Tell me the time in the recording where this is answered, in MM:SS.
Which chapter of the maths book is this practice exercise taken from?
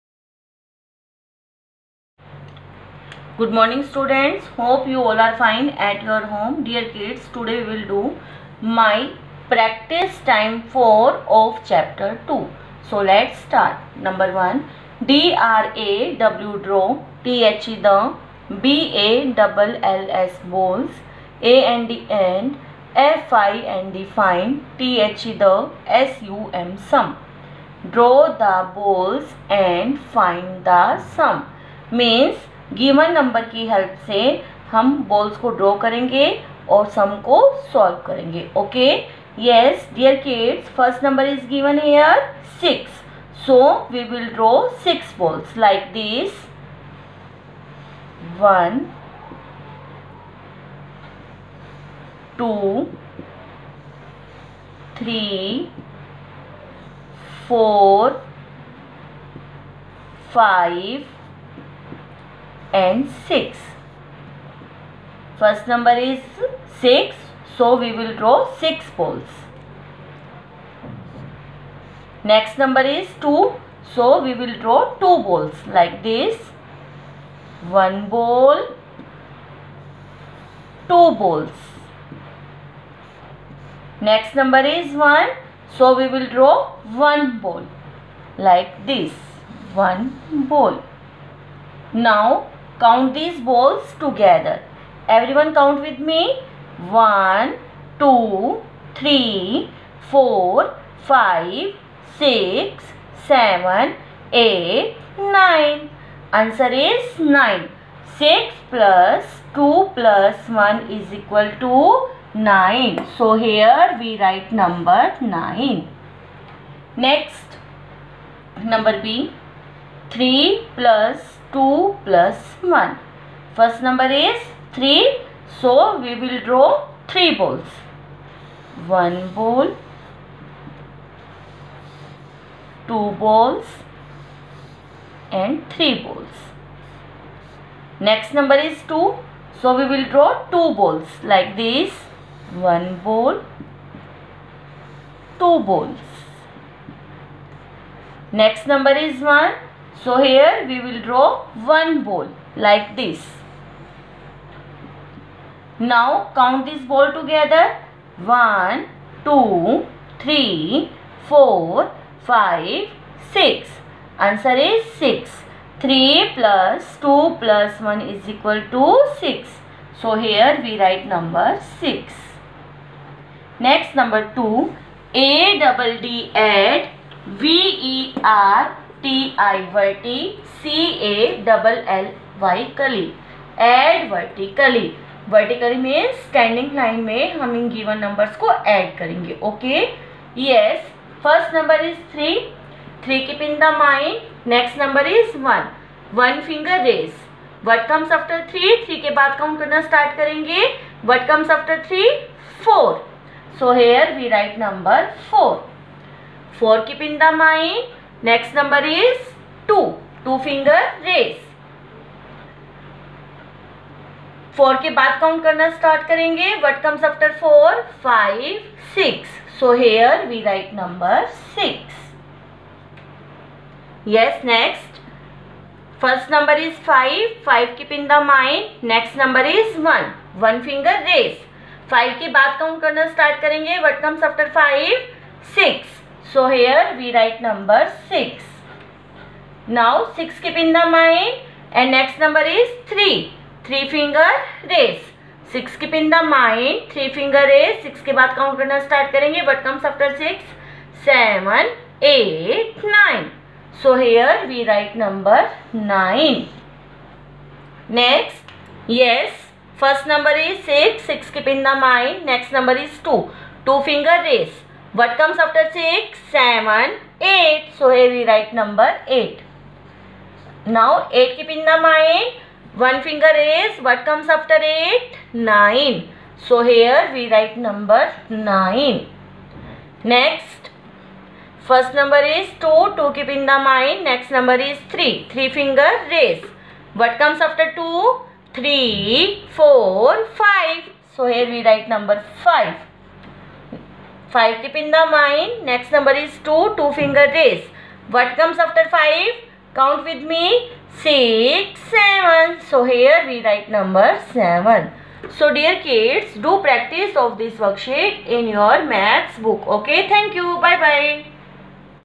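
00:11.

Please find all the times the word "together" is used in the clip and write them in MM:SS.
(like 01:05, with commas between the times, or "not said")
01:34, 02:37.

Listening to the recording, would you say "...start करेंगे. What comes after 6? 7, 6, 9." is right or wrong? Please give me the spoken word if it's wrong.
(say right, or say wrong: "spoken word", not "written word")
wrong: "8", not "6".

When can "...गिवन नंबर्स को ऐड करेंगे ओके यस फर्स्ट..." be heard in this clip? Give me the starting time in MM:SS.
03:07.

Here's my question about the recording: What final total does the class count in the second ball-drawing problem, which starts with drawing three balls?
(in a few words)
6.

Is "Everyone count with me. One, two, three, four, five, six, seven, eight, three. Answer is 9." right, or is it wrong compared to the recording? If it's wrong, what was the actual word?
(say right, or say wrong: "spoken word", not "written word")
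wrong: "nine", not "three".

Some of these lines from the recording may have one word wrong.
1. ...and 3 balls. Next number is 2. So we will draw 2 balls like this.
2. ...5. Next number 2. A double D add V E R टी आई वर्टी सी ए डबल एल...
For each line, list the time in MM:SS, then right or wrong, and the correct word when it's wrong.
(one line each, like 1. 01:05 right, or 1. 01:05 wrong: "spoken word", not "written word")
1. 02:15 right
2. 02:51 wrong: "6", not "5".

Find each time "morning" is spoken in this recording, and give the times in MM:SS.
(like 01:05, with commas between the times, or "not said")
00:03.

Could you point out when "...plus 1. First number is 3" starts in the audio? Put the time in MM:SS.
02:02.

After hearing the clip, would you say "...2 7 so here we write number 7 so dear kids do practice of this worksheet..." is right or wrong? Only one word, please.
wrong.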